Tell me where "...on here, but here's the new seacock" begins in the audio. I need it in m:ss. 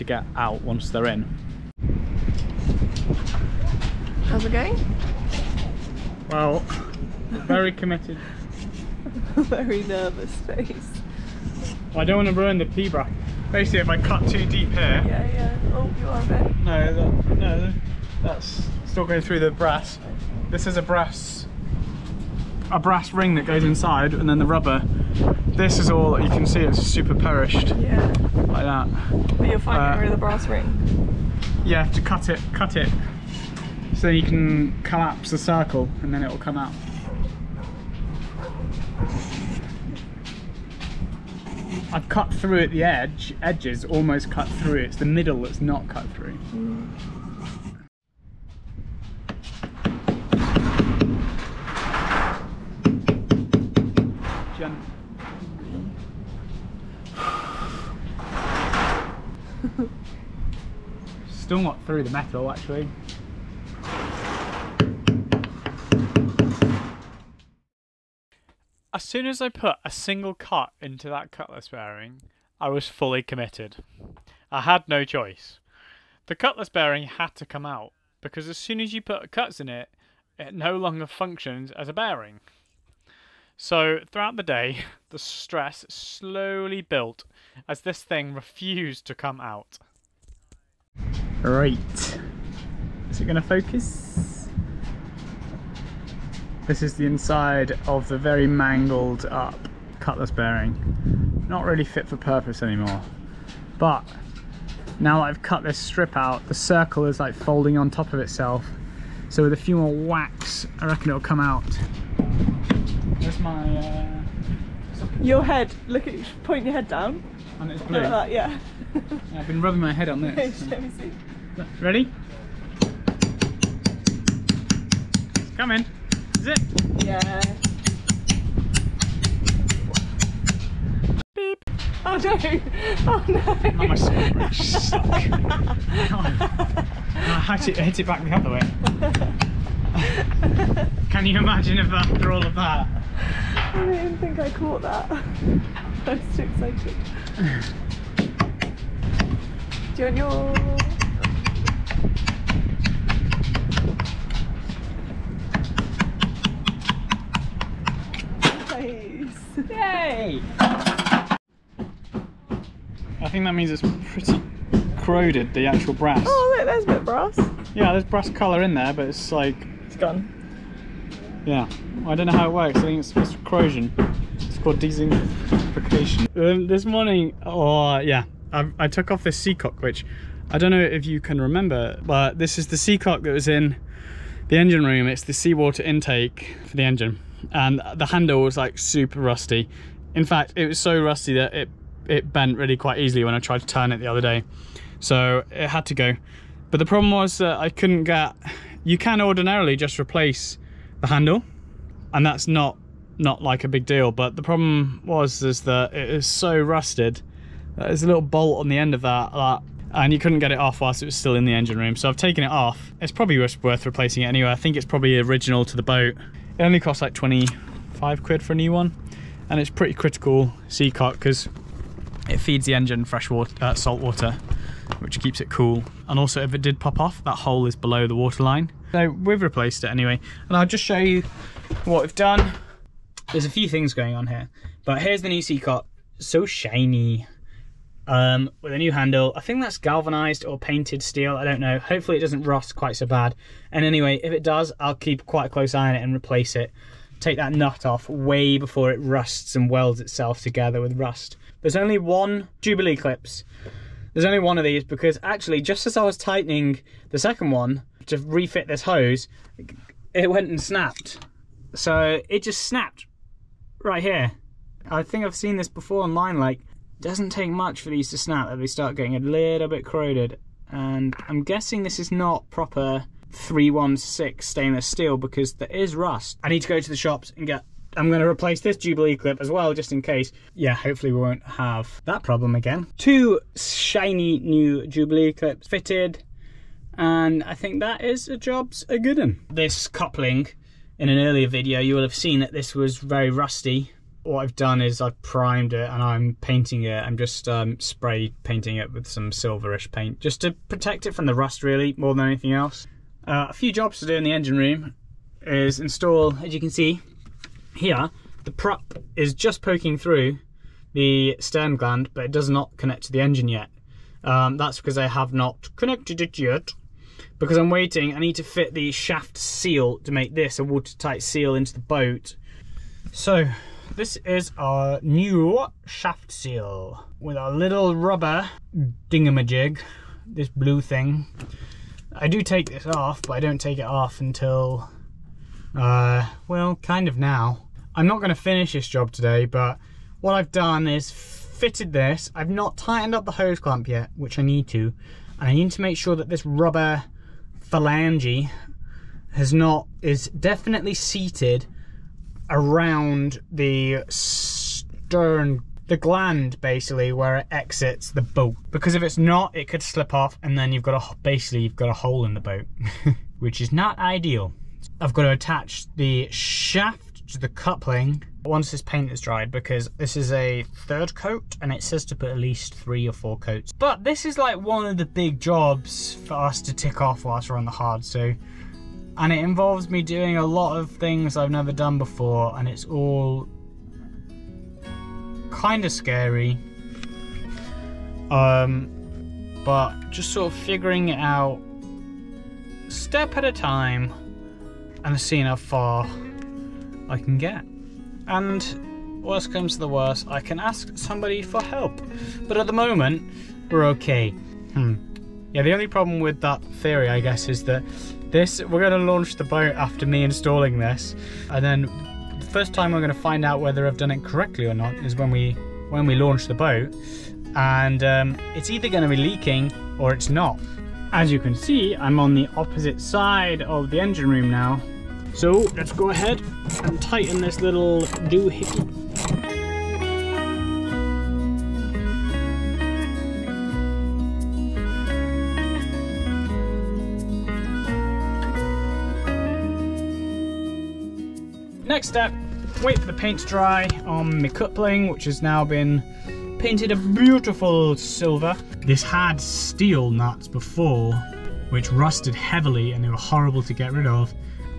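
3:54.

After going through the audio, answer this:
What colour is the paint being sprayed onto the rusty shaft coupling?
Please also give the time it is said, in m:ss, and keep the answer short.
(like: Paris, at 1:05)
Silver, at 4:59.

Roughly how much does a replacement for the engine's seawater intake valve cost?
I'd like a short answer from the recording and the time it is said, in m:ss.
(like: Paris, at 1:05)
25 quid, at 3:37.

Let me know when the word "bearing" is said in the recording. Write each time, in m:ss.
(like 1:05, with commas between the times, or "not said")
1:11, 1:16, 1:21, 1:40.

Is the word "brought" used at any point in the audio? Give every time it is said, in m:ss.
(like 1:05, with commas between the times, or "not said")
not said.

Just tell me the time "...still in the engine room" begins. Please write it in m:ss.
3:31.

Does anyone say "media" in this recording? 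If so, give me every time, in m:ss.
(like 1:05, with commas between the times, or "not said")
not said.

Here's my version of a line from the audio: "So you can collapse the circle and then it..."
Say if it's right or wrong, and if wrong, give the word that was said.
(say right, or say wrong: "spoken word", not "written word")
right.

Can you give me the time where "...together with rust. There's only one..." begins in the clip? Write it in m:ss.
4:10.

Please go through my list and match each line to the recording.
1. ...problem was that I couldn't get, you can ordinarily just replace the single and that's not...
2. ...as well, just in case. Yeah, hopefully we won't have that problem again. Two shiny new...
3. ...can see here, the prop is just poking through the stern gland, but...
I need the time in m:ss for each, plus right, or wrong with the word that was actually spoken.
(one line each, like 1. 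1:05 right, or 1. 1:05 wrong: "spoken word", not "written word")
1. 3:16 wrong: "handle", not "single"
2. 4:39 right
3. 5:06 right.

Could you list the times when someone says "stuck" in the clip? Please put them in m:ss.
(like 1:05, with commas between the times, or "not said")
2:13.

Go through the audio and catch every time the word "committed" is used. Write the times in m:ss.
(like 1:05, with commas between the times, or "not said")
0:07, 1:13.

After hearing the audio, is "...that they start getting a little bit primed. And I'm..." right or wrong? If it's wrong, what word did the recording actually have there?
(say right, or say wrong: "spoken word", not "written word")
wrong: "corroded", not "primed".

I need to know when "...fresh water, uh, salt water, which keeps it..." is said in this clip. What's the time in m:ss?
3:43.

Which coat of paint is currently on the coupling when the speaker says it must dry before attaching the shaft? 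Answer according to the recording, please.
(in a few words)
Third coat.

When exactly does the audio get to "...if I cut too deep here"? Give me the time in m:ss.
0:13.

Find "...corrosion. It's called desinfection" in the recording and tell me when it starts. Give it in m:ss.
2:53.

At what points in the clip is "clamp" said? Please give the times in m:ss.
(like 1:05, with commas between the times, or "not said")
5:43.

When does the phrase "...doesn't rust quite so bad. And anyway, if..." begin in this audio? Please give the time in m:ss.
4:02.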